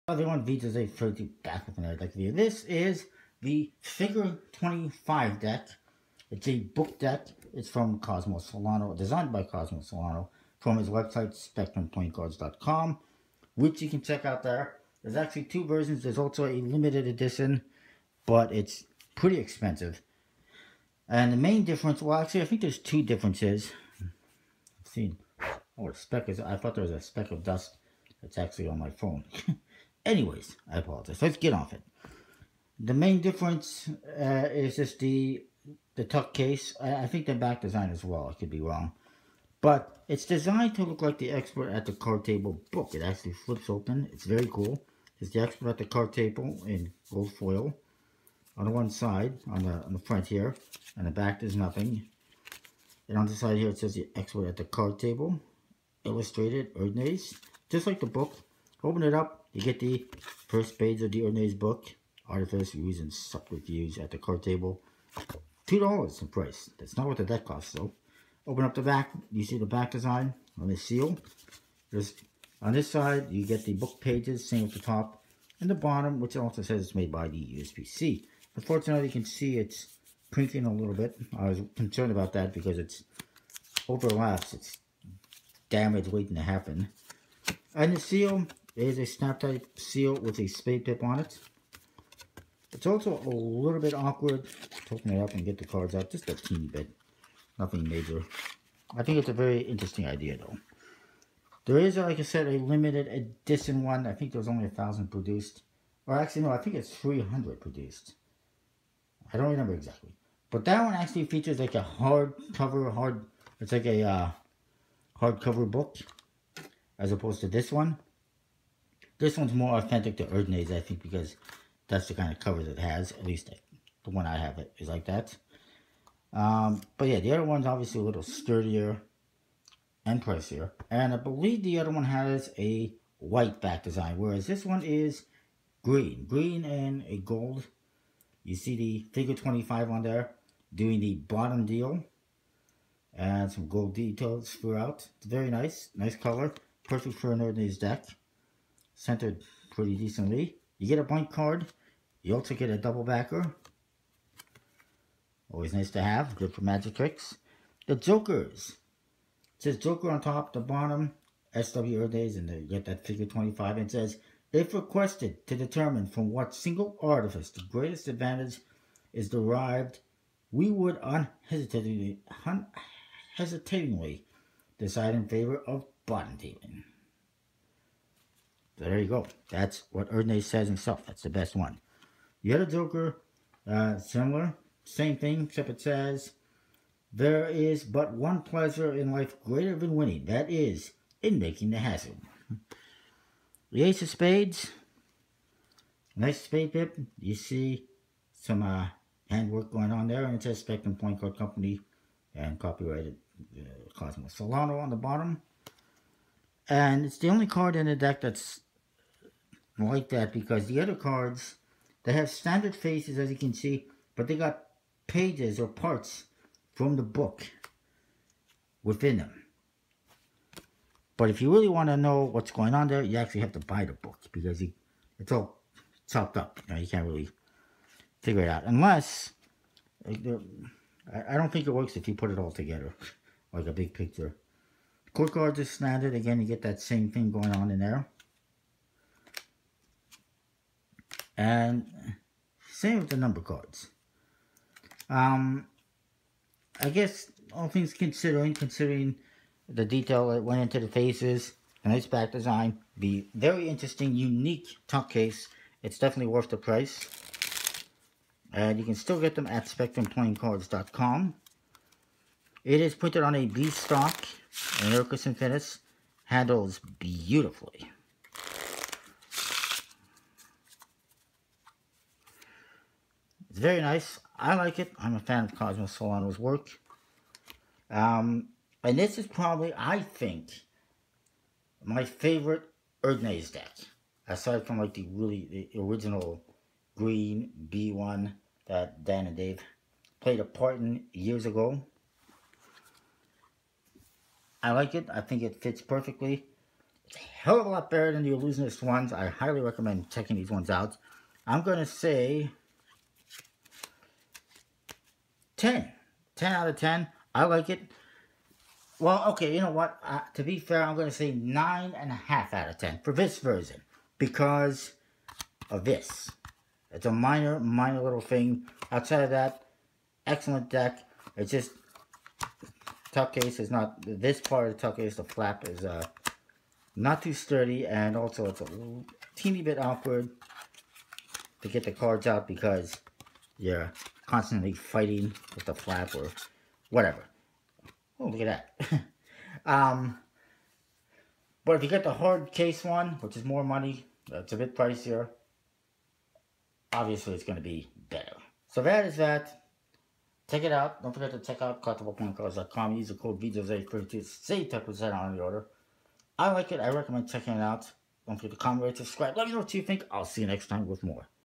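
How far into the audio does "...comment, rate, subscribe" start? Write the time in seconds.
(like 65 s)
358 s.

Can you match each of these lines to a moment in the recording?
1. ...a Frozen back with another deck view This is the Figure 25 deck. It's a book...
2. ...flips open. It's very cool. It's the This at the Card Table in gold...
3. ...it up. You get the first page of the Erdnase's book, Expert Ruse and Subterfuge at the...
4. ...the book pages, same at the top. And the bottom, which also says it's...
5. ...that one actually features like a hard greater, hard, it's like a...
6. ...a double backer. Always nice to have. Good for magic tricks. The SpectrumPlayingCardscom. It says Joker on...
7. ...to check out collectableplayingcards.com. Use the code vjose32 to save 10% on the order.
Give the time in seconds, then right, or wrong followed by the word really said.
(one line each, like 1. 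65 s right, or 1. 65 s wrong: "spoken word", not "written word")
1. 0 s right
2. 43 s wrong: "Expert", not "This"
3. 59 s wrong: "Artifice", not "Expert"
4. 73 s right
5. 110 s wrong: "cover", not "greater"
6. 152 s wrong: "Jokers", not "SpectrumPlayingCardscom"
7. 351 s right.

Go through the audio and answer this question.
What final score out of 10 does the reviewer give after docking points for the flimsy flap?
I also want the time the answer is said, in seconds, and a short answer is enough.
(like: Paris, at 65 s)
9.5, at 311 s.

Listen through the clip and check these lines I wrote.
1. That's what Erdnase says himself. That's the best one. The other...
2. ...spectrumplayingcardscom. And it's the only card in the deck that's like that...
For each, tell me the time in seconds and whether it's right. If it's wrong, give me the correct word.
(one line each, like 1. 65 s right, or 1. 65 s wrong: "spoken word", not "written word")
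1. 179 s right
2. 204 s wrong: "bottom", not "spectrumplayingcardscom".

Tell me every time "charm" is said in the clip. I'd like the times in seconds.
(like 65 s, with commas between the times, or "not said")
not said.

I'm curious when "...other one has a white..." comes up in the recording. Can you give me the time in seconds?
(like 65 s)
131 s.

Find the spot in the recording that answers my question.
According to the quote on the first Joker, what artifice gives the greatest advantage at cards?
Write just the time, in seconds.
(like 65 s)
176 s.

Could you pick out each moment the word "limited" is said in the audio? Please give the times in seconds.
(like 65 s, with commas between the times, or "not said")
16 s, 102 s.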